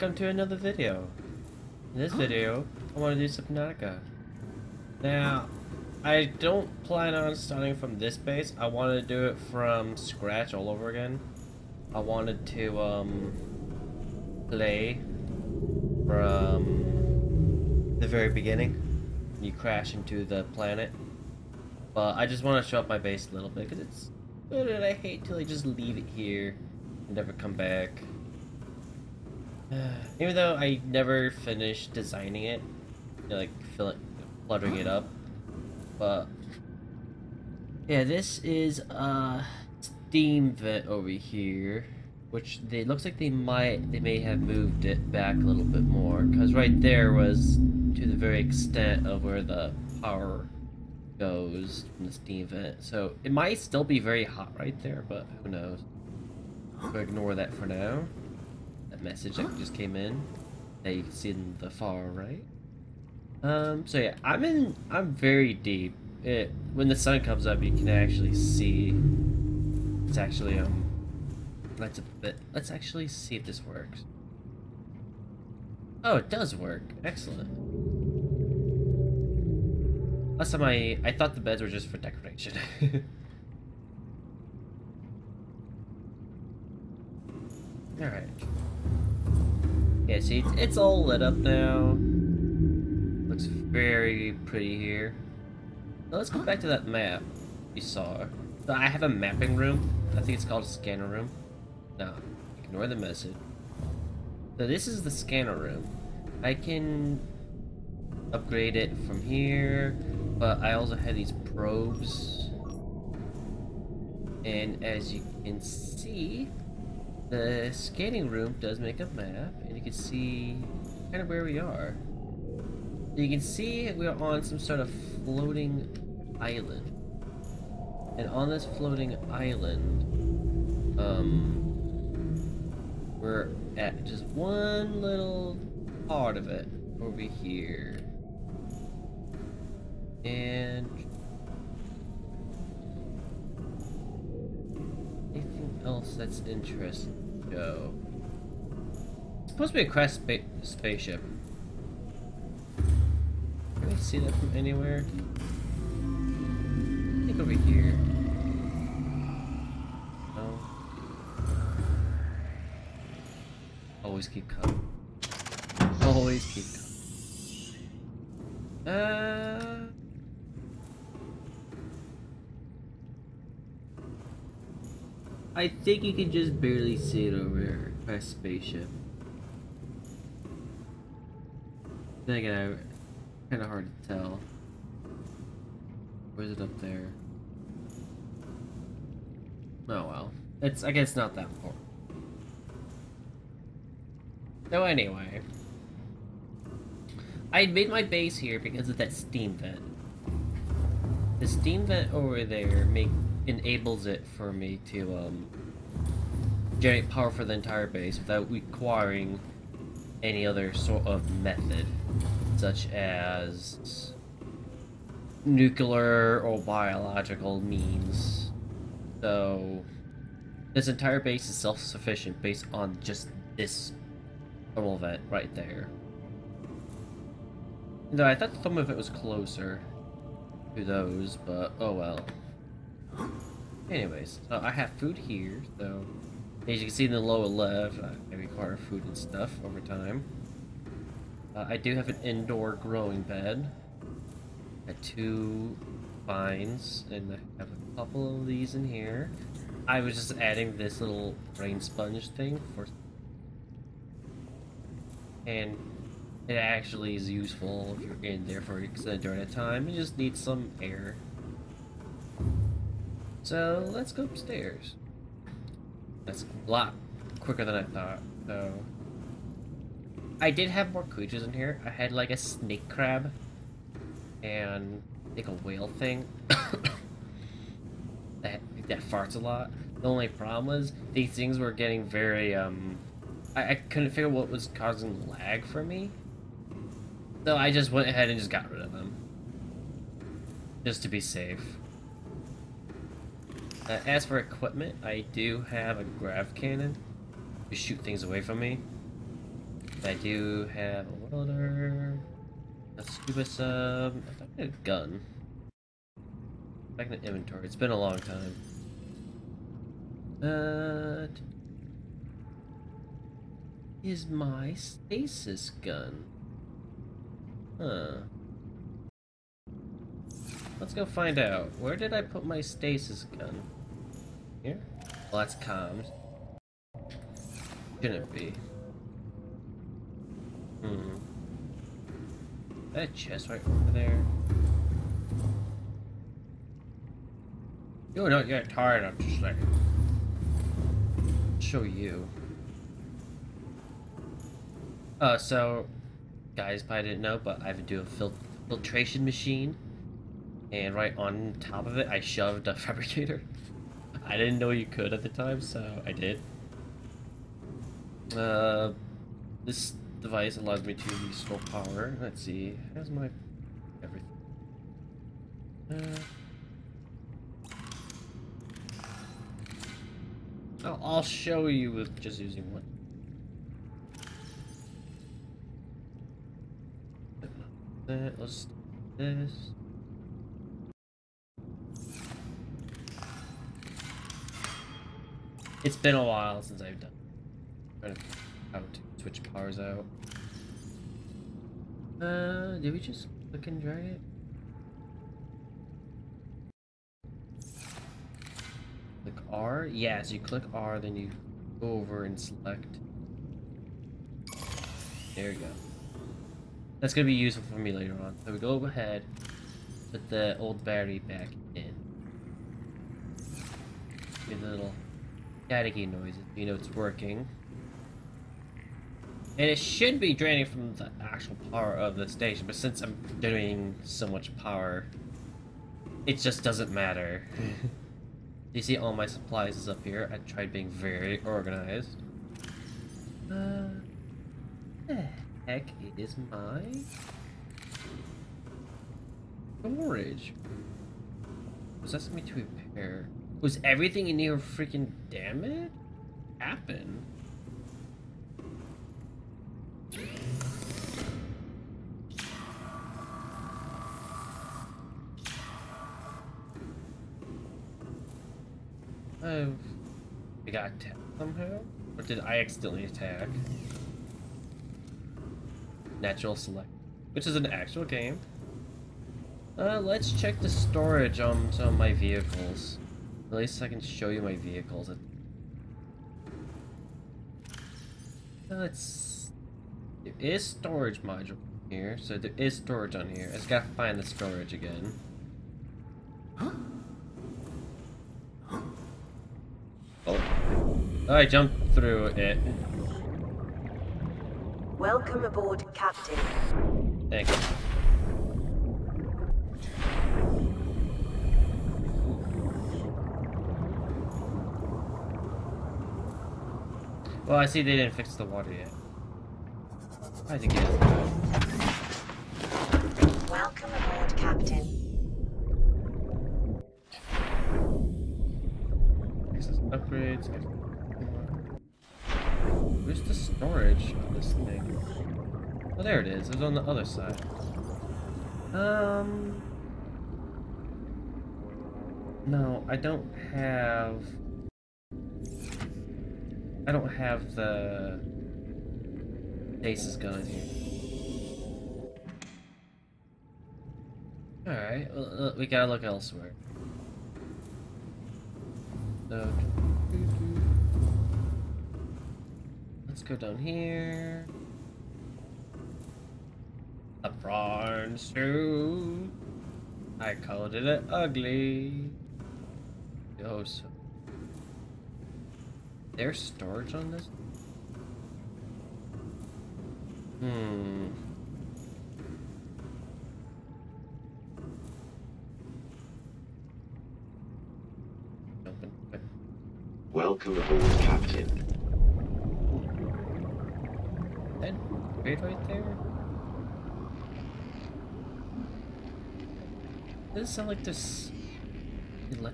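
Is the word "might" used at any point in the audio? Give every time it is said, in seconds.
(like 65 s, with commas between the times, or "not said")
43 s, 53 s.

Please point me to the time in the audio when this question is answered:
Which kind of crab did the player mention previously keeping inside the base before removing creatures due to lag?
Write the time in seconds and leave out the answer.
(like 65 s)
272 s.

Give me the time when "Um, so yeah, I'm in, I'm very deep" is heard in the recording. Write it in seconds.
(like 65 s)
63 s.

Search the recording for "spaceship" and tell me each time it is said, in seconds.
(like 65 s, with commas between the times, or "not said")
150 s, 178 s.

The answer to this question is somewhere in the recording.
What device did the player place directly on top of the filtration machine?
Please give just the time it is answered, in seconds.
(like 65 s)
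352 s.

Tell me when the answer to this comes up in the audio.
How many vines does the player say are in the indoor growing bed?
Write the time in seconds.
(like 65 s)
244 s.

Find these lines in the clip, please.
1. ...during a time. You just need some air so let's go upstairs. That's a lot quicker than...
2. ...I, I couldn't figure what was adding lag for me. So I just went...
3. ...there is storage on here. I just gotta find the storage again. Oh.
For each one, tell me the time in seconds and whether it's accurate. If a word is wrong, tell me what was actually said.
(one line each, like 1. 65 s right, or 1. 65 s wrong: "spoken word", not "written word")
1. 259 s right
2. 283 s wrong: "causing", not "adding"
3. 482 s right.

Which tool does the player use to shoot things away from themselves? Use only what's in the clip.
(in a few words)
grav cannon.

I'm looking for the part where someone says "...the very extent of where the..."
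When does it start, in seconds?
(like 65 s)
48 s.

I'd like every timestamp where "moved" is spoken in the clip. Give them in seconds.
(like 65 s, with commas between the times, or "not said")
44 s.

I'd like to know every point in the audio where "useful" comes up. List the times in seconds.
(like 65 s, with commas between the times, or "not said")
257 s, 407 s.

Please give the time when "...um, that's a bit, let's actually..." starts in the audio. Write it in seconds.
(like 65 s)
70 s.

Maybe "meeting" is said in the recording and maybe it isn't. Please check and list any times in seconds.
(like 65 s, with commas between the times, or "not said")
not said.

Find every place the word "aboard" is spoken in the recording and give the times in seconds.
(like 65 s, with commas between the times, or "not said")
495 s, 513 s, 580 s.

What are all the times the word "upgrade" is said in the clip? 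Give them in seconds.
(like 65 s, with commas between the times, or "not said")
108 s, 519 s.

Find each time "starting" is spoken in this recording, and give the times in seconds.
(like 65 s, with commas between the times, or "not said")
7 s.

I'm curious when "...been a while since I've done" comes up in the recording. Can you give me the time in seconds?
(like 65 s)
385 s.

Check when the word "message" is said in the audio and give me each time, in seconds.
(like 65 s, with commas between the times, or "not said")
59 s, 102 s.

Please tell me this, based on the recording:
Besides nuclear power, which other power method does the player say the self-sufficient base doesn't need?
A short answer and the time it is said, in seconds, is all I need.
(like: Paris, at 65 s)
biological, at 216 s.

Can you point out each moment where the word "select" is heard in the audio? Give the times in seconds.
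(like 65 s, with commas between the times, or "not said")
402 s, 466 s.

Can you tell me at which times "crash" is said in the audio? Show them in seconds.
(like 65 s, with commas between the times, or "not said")
19 s, 149 s.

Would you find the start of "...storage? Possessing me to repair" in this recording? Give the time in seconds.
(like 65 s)
439 s.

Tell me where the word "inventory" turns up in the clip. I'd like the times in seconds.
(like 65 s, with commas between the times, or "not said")
307 s.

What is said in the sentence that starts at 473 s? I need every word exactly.
At least I can show you my vehicles.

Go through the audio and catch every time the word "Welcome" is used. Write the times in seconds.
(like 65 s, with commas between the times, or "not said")
494 s, 513 s, 580 s.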